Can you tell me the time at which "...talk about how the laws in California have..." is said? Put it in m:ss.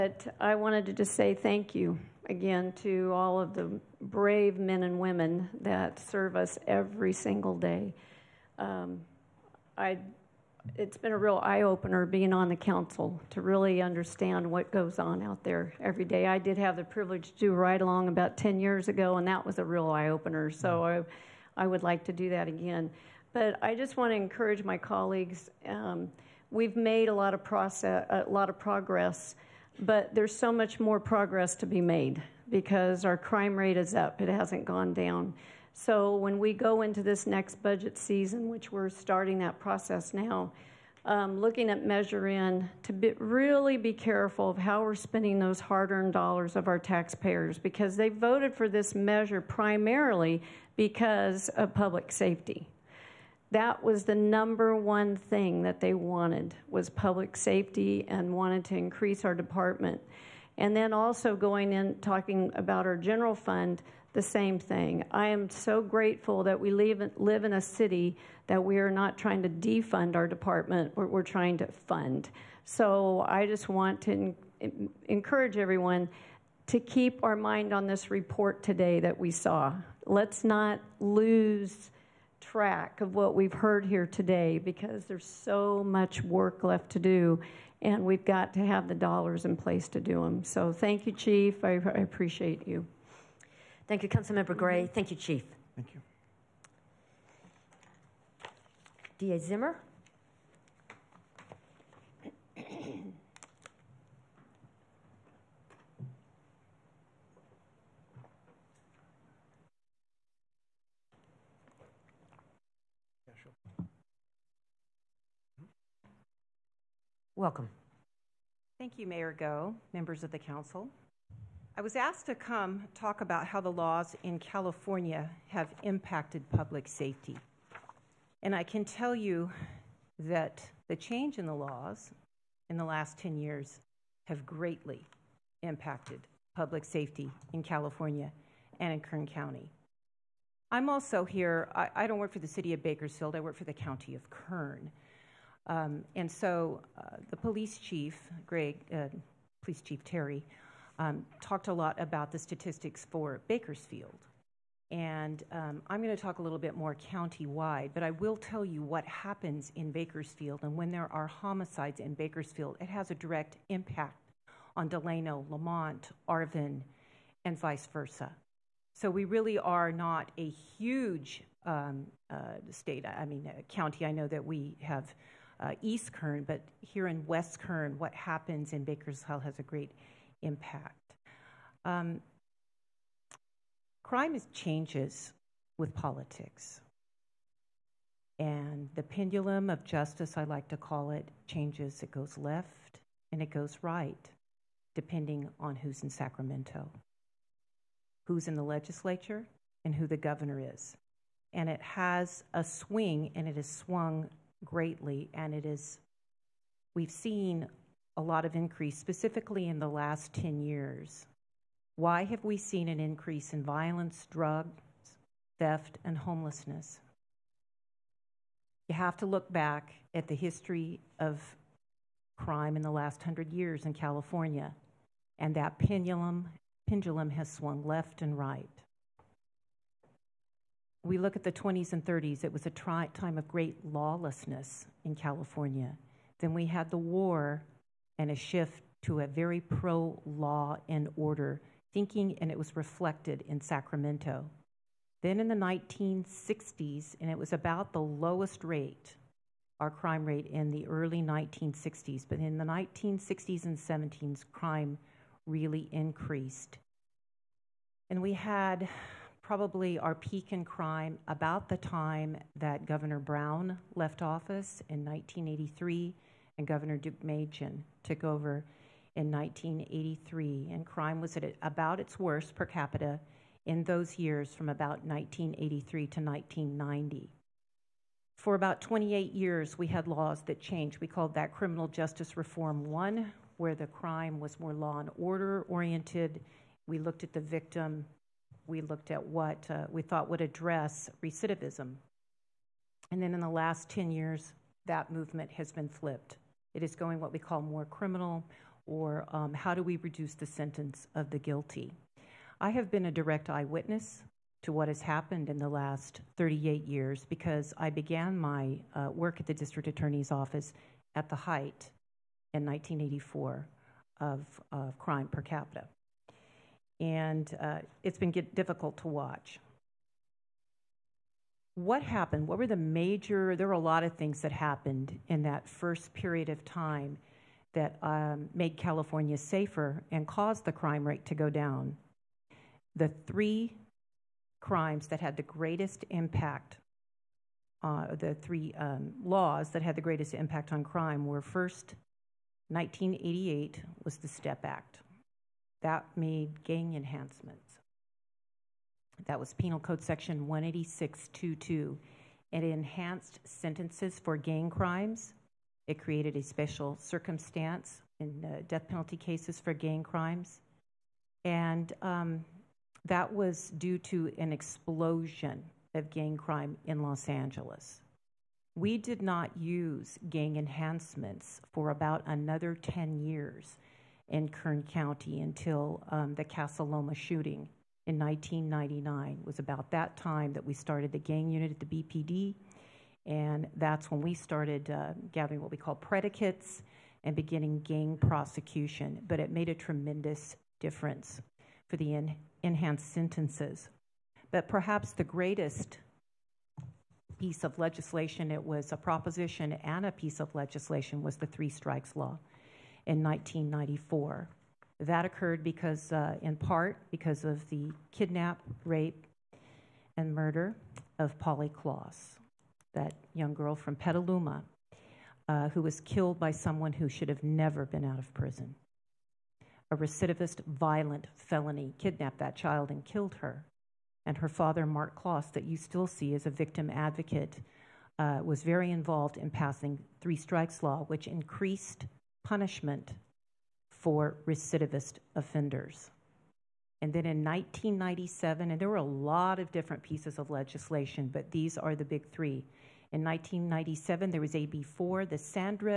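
2:02.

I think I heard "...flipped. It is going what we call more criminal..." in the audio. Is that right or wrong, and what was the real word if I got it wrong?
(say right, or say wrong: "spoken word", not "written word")
right.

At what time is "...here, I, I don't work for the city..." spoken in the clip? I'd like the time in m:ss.
2:21.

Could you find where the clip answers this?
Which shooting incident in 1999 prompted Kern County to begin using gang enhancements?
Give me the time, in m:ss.
6:16.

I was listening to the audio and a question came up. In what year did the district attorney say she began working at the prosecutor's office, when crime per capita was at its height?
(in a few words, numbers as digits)
1984.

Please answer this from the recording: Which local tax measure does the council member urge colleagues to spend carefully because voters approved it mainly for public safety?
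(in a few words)
Measure N.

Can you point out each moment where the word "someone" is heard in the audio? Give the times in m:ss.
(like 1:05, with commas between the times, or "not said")
6:56.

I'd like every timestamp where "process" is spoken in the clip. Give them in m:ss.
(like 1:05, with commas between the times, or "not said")
0:27, 0:39.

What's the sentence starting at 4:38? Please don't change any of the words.
For about 28 years, we had laws that changed.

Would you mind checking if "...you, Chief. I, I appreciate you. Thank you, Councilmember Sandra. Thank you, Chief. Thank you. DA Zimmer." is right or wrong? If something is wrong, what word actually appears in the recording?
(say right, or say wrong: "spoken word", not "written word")
wrong: "Gray", not "Sandra".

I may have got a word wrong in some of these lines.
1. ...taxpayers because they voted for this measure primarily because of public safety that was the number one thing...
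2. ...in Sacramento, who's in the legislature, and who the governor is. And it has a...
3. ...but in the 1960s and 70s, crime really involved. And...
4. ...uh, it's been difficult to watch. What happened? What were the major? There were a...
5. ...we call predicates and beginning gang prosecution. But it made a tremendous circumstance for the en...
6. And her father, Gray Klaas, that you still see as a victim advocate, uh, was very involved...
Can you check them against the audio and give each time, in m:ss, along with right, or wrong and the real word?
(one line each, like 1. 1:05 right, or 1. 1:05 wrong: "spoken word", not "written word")
1. 0:46 right
2. 3:16 right
3. 4:12 wrong: "increased", not "involved"
4. 5:17 right
5. 6:25 wrong: "difference", not "circumstance"
6. 7:04 wrong: "Marc", not "Gray".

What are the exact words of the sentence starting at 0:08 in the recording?
Um, I, it's been a real eye opener being on the council to really understand what goes on out there every day.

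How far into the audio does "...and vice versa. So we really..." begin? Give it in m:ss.
2:47.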